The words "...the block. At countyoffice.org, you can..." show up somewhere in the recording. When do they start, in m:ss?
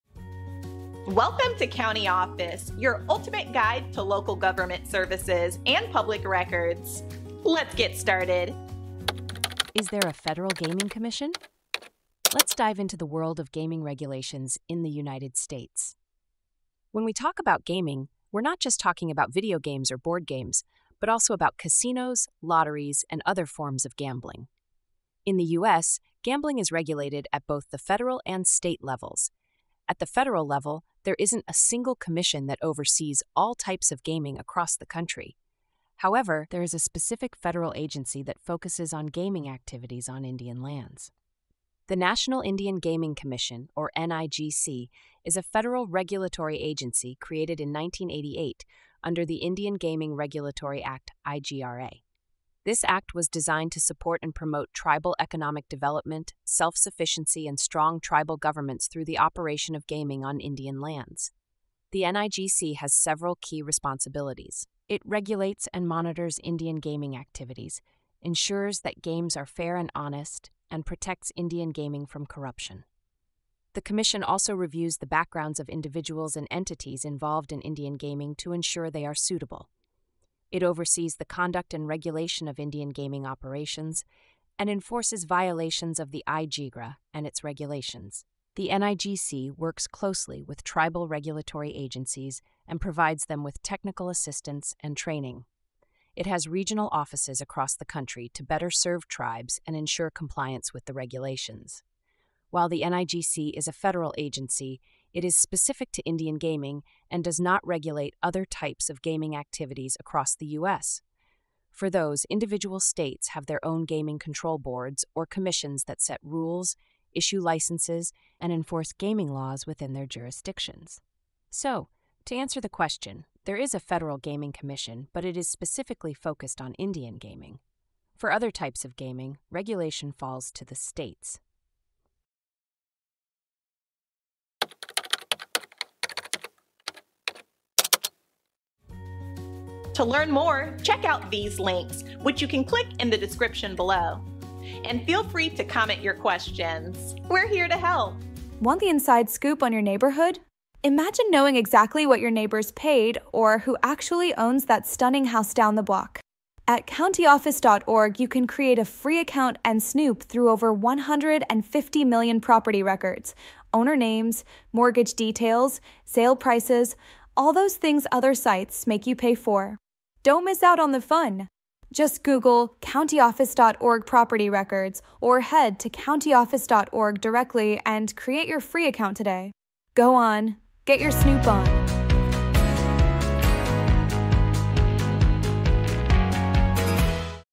2:35.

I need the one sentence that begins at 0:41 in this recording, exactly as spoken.
The National Indian Gaming Commission, or NIGC, is a federal regulatory agency created in 1988 under the Indian Gaming Regulatory Act, IGRA.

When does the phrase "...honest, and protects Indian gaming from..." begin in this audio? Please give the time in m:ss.
1:09.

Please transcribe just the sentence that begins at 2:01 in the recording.
So, to answer the question, there is a federal gaming commission, but it is specifically focused on Indian gaming.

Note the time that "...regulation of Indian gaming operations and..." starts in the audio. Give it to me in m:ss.
1:21.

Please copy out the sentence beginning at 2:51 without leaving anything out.
Just Google countyoffice.org property records or head to countyoffice.org directly and create your free account today.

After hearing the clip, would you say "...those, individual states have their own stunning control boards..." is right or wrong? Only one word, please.
wrong.